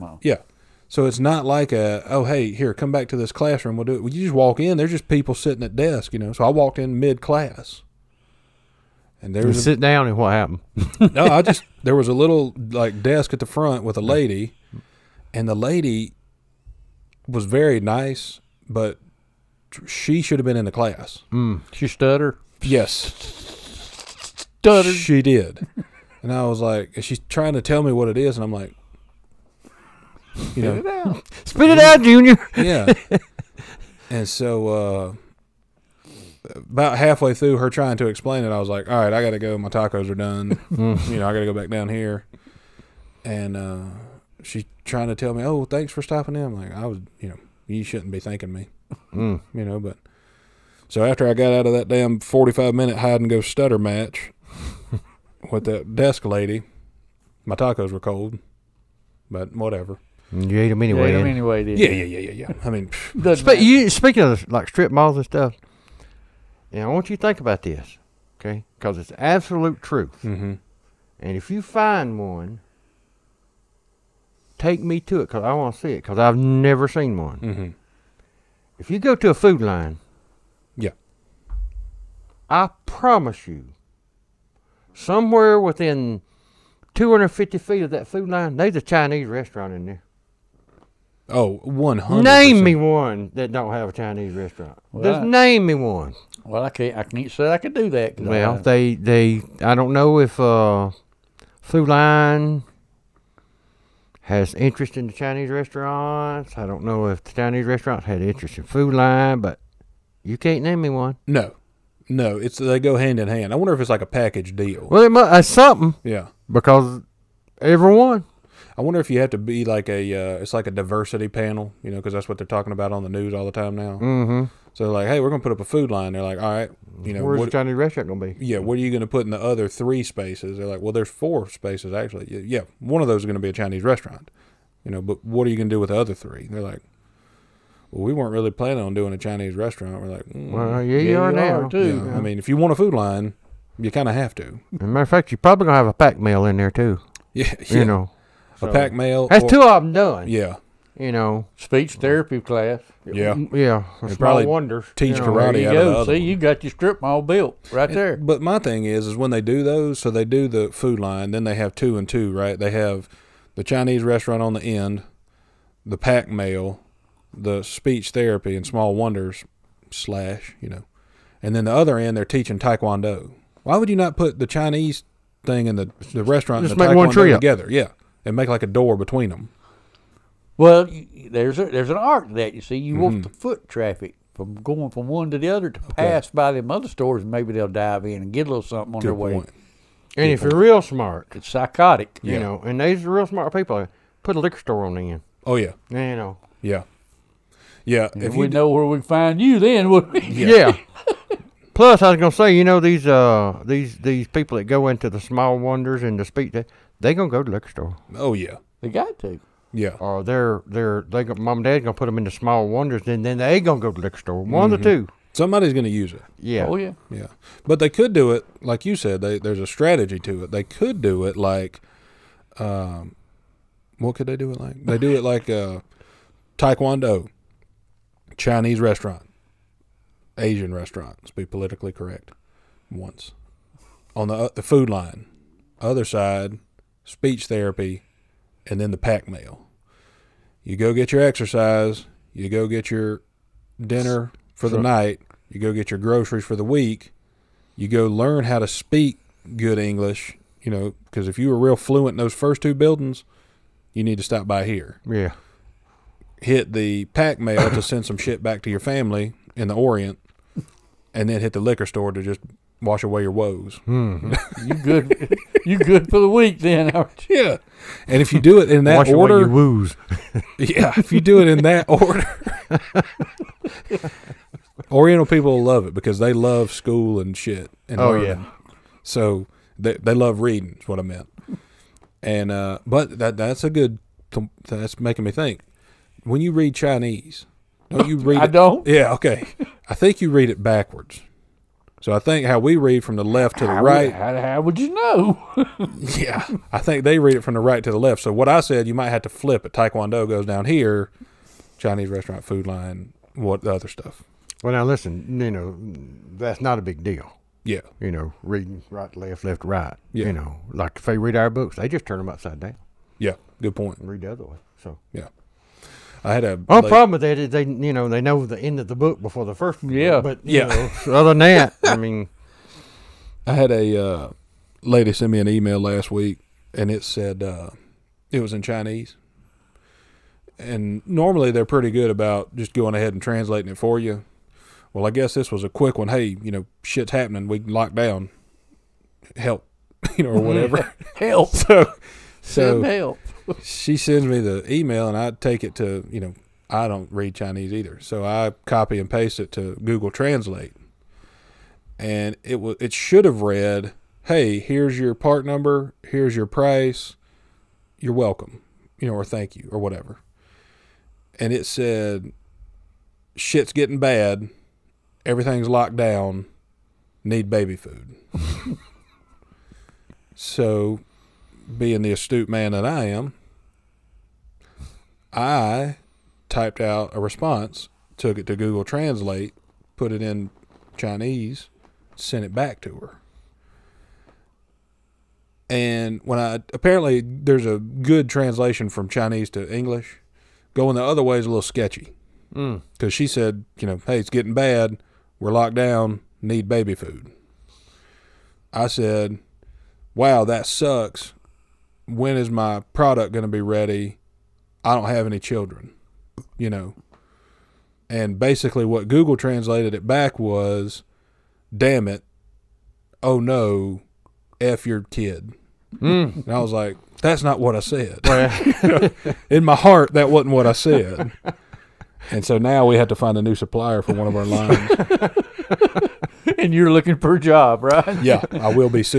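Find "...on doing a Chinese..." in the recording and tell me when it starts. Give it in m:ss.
2:18.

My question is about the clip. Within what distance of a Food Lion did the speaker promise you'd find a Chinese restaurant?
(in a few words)
250 feet.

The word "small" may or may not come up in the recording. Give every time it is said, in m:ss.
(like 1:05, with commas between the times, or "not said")
2:48, 3:25, 3:32.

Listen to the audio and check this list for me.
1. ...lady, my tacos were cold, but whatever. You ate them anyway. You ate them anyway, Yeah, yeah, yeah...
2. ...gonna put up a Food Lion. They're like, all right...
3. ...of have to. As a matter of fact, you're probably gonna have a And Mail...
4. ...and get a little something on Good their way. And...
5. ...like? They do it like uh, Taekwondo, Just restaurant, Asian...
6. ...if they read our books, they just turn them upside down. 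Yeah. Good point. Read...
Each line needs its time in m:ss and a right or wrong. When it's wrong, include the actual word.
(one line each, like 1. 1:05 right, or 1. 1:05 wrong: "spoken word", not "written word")
1. 0:56 right
2. 2:05 right
3. 2:24 wrong: "Pak", not "And"
4. 3:08 right
5. 3:44 wrong: "Chinese", not "Just"
6. 5:10 right.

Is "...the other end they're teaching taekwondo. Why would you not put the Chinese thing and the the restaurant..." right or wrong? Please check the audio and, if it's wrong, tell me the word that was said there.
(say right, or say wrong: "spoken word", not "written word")
right.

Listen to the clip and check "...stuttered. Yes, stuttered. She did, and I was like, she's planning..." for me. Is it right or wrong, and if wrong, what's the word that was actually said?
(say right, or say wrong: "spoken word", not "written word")
wrong: "trying", not "planning".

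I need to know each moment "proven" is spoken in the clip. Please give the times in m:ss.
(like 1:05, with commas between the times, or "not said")
not said.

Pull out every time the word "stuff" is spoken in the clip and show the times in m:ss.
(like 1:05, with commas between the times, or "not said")
1:05, 5:03.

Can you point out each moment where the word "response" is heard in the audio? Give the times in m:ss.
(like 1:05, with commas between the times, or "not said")
6:17.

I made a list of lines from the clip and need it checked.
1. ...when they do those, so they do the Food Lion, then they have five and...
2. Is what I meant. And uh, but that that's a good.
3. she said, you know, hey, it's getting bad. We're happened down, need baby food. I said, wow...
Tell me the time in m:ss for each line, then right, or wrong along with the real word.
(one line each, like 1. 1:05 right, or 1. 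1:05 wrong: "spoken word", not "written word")
1. 2:39 wrong: "two", not "five"
2. 4:40 right
3. 6:33 wrong: "locked", not "happened".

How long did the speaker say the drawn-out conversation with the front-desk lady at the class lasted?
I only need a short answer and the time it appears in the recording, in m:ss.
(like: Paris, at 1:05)
45 minutes, at 0:52.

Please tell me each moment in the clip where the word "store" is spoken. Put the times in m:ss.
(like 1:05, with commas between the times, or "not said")
3:06, 3:14, 3:27, 3:34, 4:21.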